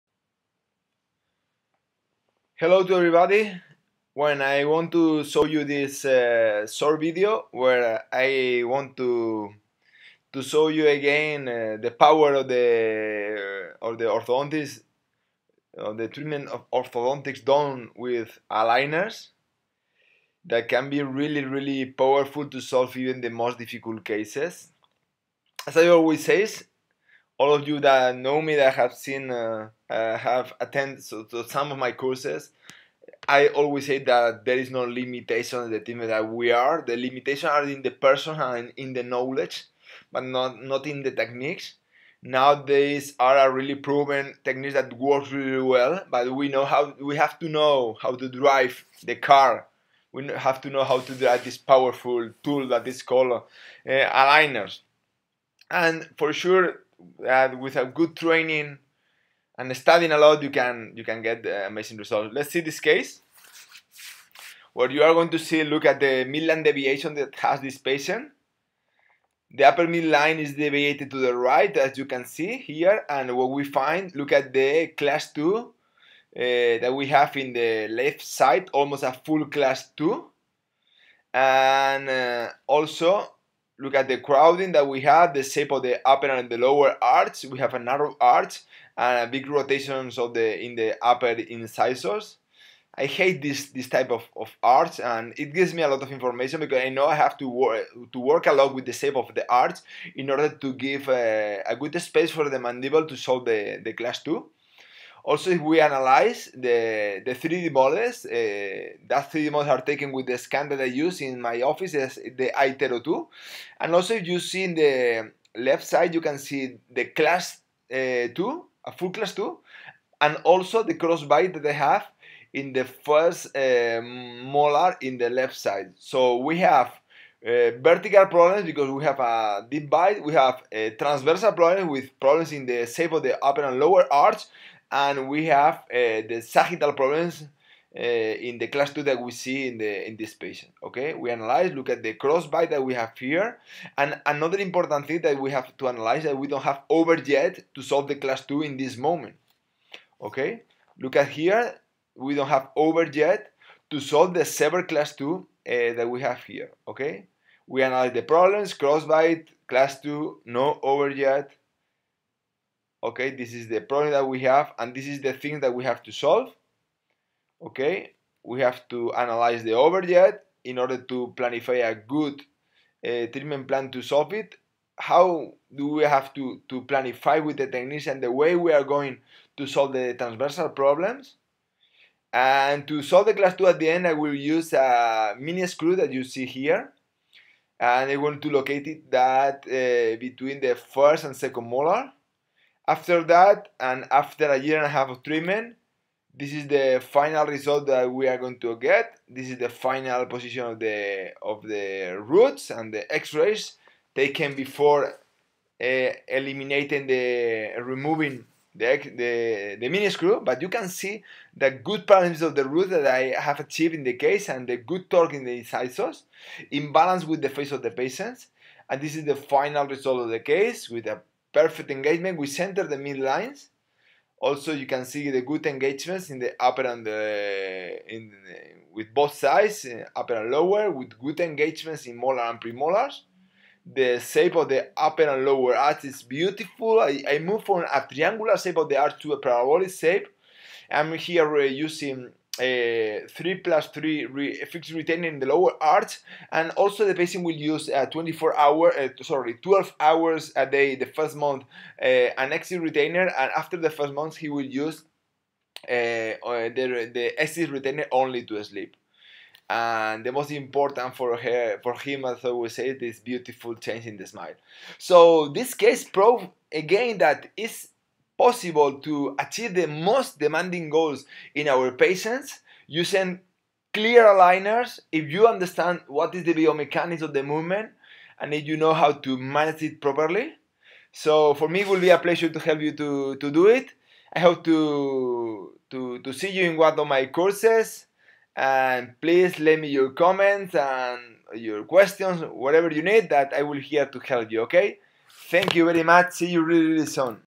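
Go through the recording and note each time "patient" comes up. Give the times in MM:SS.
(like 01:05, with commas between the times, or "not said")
01:07, 02:20, 03:37, 04:07, 04:32.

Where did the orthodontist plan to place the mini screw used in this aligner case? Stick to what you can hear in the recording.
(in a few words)
Between the first and second molar.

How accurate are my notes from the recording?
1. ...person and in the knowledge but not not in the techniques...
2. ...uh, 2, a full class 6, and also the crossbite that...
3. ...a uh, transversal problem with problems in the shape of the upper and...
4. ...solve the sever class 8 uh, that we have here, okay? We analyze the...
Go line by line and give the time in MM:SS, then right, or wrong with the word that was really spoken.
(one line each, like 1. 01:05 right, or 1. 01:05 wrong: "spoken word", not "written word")
1. 00:38 right
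2. 01:57 wrong: "2", not "6"
3. 02:10 right
4. 02:33 wrong: "2", not "8".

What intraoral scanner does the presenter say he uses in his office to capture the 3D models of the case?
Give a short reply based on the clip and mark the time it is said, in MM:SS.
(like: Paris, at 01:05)
iTero2, at 01:52.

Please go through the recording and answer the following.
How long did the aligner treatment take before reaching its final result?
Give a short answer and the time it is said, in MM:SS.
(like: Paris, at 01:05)
A year and a half, at 03:14.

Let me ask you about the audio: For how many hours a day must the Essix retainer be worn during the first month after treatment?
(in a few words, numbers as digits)
12.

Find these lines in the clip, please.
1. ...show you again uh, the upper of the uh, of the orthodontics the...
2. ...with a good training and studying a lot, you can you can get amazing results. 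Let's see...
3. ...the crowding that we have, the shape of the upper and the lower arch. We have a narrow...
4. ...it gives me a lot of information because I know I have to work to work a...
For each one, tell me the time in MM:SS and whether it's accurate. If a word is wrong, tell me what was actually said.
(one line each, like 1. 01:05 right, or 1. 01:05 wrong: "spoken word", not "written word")
1. 00:10 wrong: "power", not "upper"
2. 00:57 right
3. 01:24 right
4. 01:35 right.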